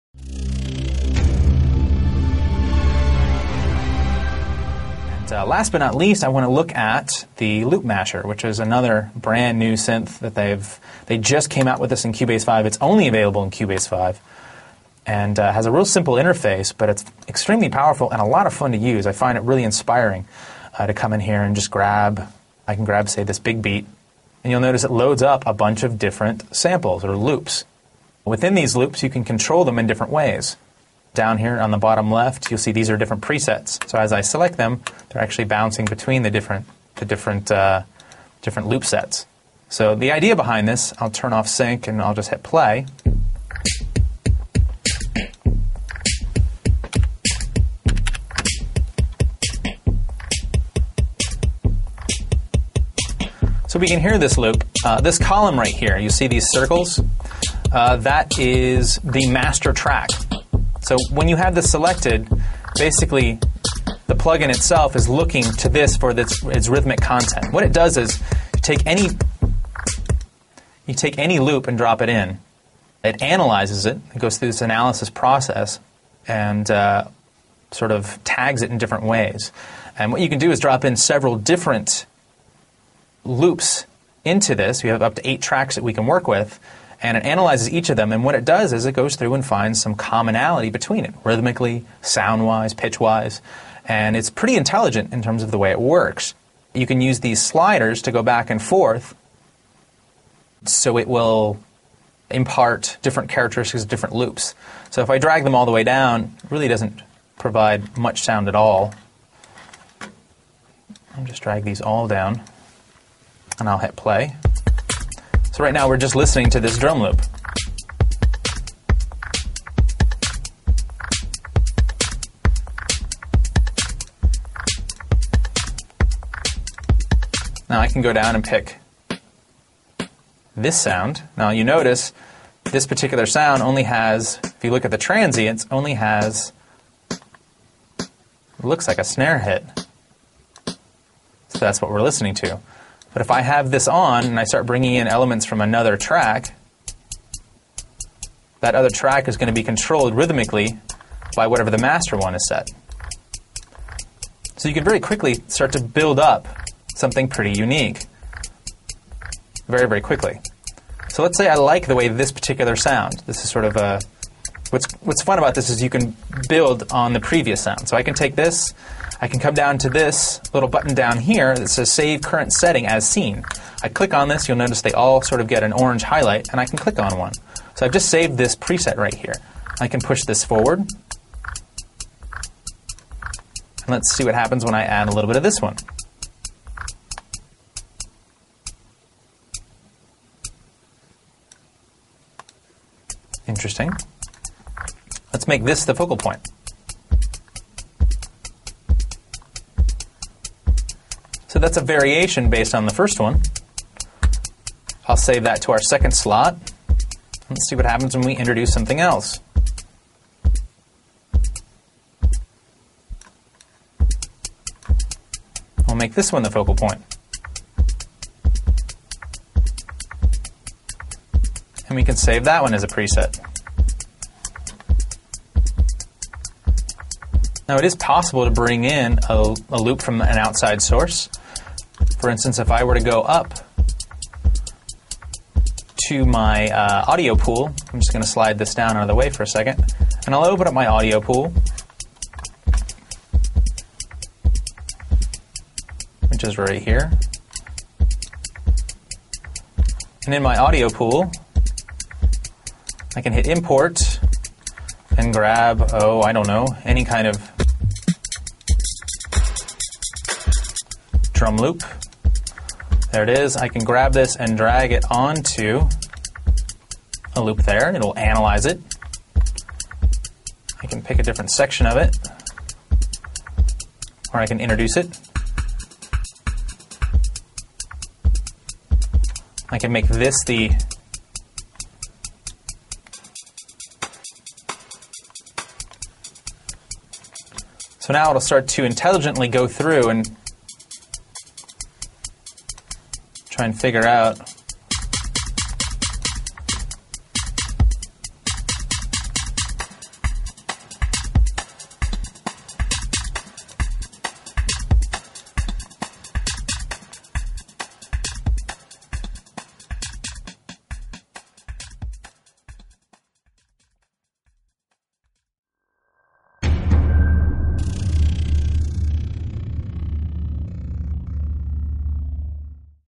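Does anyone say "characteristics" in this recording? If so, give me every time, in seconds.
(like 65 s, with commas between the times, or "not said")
103 s.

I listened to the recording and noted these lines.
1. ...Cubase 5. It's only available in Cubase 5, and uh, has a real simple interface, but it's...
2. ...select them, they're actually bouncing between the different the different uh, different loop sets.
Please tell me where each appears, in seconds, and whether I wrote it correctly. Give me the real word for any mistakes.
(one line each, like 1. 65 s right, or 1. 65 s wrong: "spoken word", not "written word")
1. 12 s right
2. 34 s right.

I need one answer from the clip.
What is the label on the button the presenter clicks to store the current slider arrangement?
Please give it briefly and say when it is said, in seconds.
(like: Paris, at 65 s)
Save Current Setting as Scene, at 171 s.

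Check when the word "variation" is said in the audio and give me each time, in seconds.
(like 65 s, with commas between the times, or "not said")
201 s.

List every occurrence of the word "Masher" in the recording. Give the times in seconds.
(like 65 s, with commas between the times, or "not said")
7 s.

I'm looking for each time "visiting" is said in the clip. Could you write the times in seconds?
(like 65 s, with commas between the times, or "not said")
not said.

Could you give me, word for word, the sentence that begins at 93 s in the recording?
And it's pretty intelligent in terms of the way it works.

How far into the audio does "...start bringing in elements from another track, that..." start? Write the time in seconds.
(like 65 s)
144 s.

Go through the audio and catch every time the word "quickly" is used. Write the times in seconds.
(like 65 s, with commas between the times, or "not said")
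154 s, 160 s.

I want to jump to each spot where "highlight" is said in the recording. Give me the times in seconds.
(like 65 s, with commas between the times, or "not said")
176 s.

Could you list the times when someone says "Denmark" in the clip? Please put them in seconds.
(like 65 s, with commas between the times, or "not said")
not said.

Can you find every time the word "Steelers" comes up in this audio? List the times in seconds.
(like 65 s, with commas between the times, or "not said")
not said.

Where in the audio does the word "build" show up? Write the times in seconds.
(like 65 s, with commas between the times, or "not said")
155 s, 166 s.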